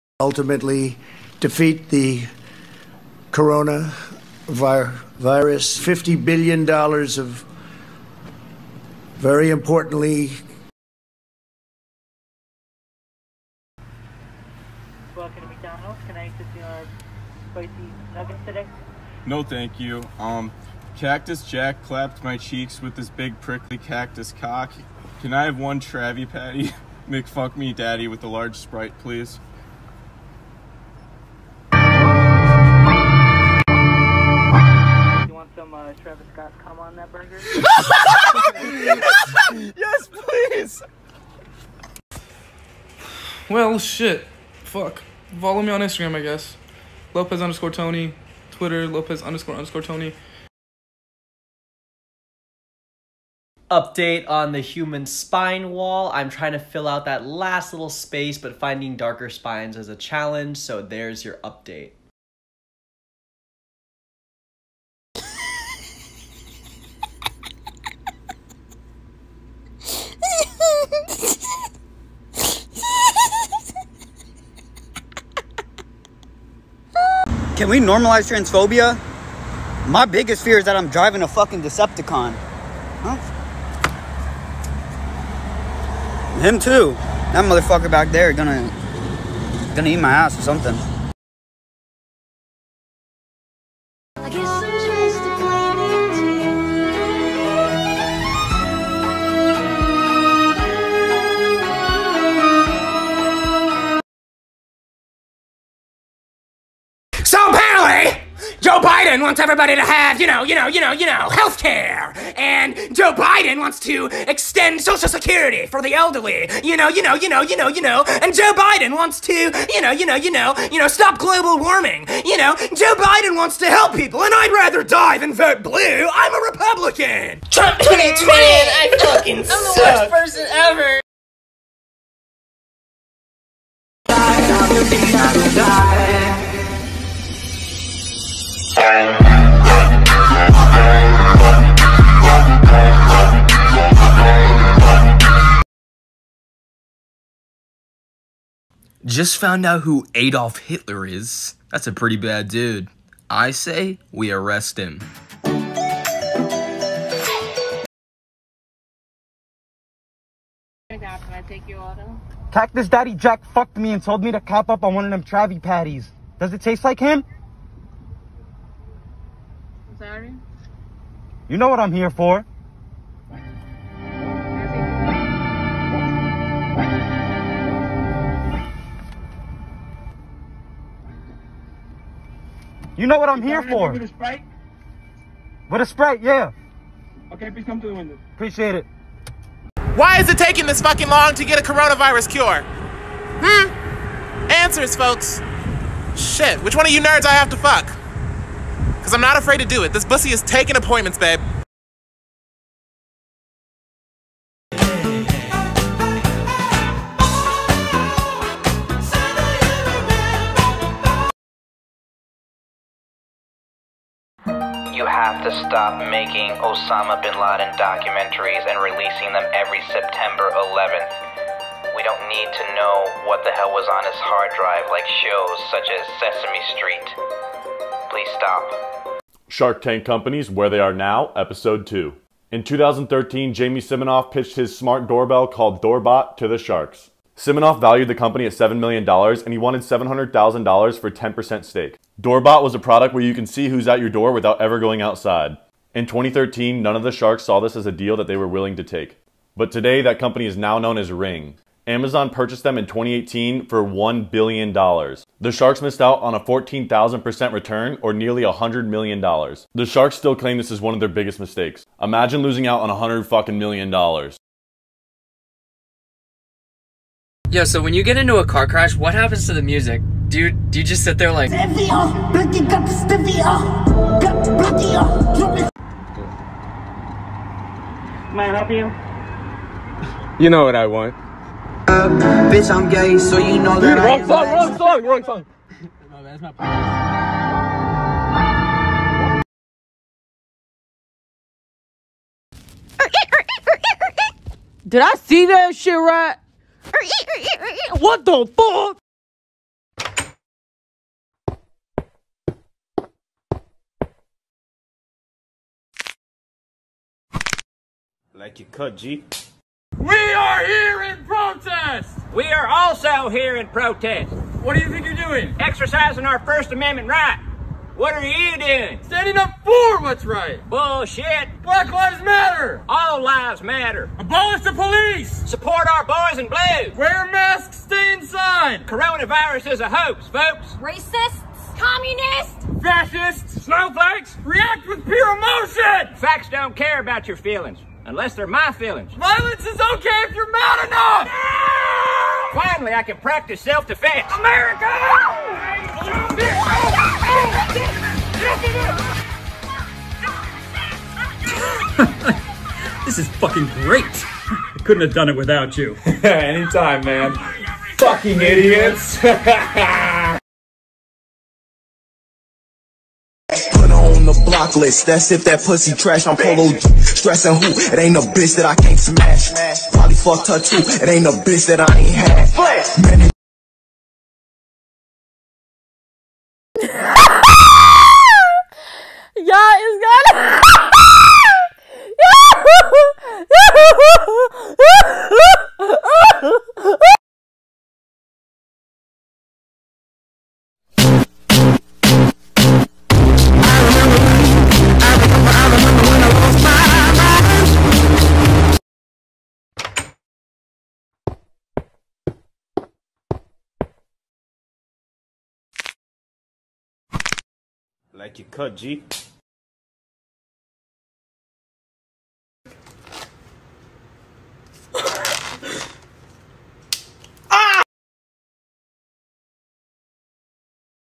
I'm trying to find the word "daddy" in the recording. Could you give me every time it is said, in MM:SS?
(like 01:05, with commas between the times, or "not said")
00:27, 02:42.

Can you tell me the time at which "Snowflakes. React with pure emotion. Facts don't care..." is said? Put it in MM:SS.
05:33.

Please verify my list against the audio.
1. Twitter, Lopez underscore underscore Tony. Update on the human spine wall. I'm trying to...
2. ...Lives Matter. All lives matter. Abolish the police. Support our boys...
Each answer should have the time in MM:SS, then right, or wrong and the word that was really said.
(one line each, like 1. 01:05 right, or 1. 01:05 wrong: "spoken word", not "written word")
1. 00:48 right
2. 05:21 right.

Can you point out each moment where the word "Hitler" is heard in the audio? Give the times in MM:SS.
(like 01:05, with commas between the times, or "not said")
02:30.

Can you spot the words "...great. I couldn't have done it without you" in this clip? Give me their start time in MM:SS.
05:53.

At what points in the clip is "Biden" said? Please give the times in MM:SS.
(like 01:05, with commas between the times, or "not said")
01:48, 01:53, 01:58, 02:02.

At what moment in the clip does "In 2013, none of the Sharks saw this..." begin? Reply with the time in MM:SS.
04:05.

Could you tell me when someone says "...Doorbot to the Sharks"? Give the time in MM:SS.
03:55.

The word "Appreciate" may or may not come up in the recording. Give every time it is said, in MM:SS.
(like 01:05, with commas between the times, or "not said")
03:08.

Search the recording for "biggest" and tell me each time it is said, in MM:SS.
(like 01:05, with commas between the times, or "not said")
01:20, 04:21.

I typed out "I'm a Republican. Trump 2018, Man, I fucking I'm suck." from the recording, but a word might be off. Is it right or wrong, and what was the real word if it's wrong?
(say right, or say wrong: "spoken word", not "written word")
wrong: "2020", not "2018".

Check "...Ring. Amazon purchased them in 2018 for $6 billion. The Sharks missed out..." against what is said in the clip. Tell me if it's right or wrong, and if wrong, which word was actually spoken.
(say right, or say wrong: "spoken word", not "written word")
wrong: "1", not "6".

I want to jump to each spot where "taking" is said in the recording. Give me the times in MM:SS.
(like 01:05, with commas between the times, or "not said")
03:10, 03:20.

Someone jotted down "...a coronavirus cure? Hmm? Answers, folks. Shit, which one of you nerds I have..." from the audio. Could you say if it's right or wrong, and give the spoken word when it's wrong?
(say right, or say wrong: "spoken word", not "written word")
right.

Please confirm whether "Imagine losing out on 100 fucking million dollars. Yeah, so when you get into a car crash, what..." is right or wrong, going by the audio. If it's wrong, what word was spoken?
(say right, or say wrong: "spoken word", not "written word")
right.